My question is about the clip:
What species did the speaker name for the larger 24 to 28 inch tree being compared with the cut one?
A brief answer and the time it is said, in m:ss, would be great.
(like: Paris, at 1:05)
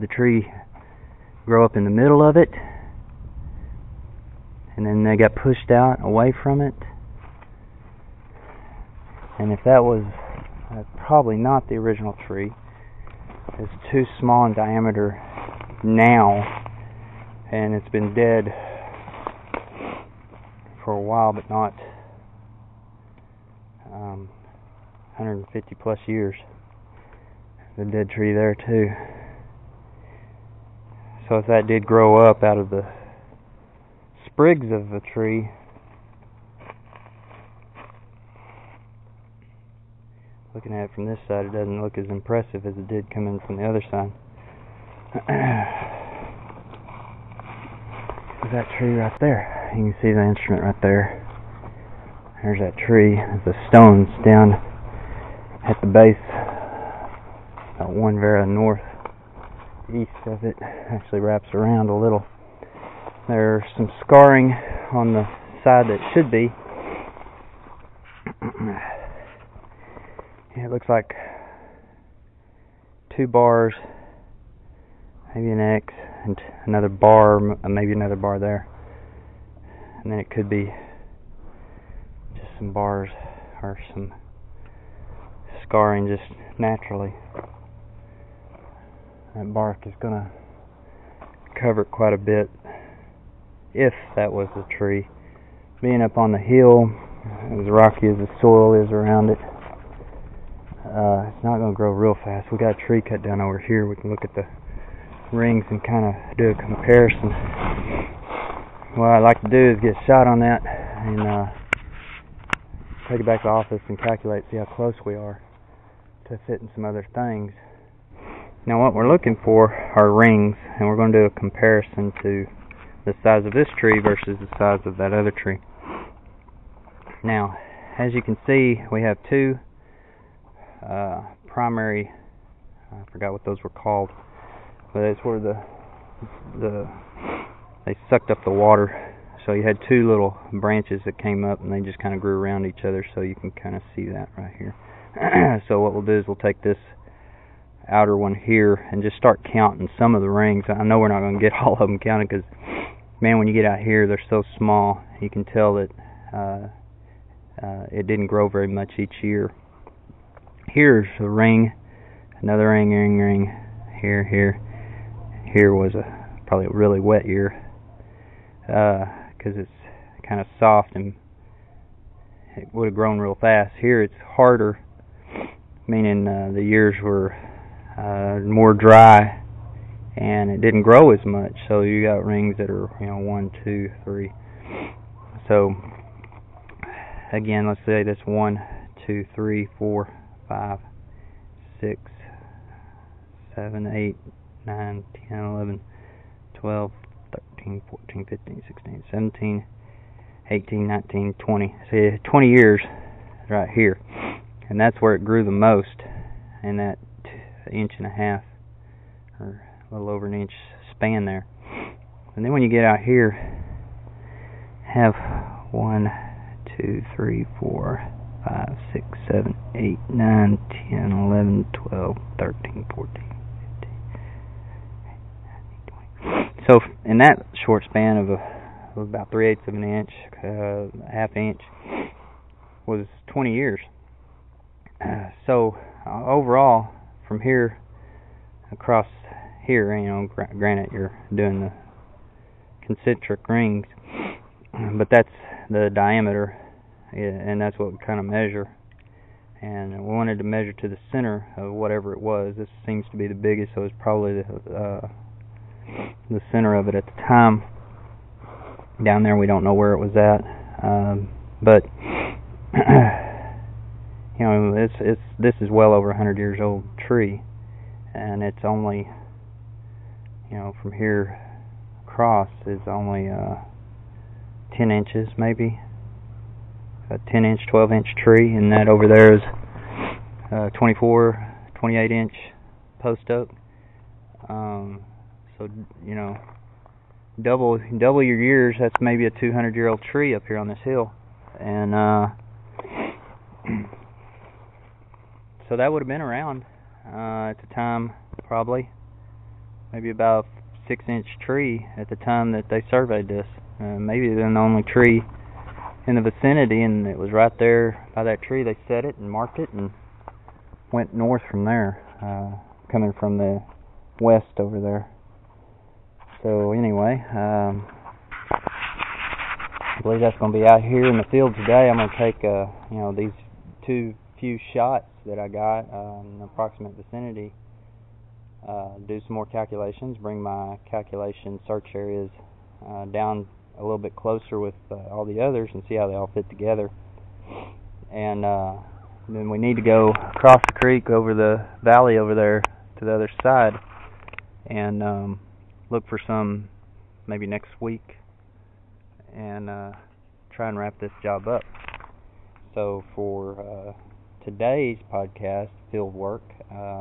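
Post oak, at 4:42.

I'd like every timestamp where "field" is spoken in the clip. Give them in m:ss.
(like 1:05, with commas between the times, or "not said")
5:21, 5:55.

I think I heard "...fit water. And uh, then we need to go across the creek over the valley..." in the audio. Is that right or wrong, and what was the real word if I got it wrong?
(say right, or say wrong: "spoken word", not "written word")
wrong: "together", not "water".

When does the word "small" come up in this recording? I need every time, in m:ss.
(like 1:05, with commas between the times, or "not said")
0:14, 2:34.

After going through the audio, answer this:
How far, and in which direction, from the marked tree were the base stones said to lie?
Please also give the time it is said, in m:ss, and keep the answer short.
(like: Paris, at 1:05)
1 vara northeast, at 0:57.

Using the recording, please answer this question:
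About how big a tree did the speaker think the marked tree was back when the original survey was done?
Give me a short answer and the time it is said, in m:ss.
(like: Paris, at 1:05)
6 inches, at 5:00.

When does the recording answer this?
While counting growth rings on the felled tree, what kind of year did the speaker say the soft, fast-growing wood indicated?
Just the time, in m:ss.
2:46.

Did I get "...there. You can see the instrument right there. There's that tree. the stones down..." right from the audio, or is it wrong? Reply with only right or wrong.
right.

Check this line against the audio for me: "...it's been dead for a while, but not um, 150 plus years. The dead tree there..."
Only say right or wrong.
right.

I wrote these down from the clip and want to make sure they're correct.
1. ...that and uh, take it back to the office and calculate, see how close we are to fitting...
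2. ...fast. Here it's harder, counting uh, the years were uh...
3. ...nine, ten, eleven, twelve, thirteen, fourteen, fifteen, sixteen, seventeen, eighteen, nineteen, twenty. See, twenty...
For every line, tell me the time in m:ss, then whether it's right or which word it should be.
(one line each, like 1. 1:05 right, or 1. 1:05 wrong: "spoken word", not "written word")
1. 1:50 right
2. 2:53 wrong: "meaning", not "counting"
3. 3:14 right.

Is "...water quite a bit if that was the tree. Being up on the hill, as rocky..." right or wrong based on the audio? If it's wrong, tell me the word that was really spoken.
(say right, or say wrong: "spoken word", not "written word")
wrong: "cover", not "water".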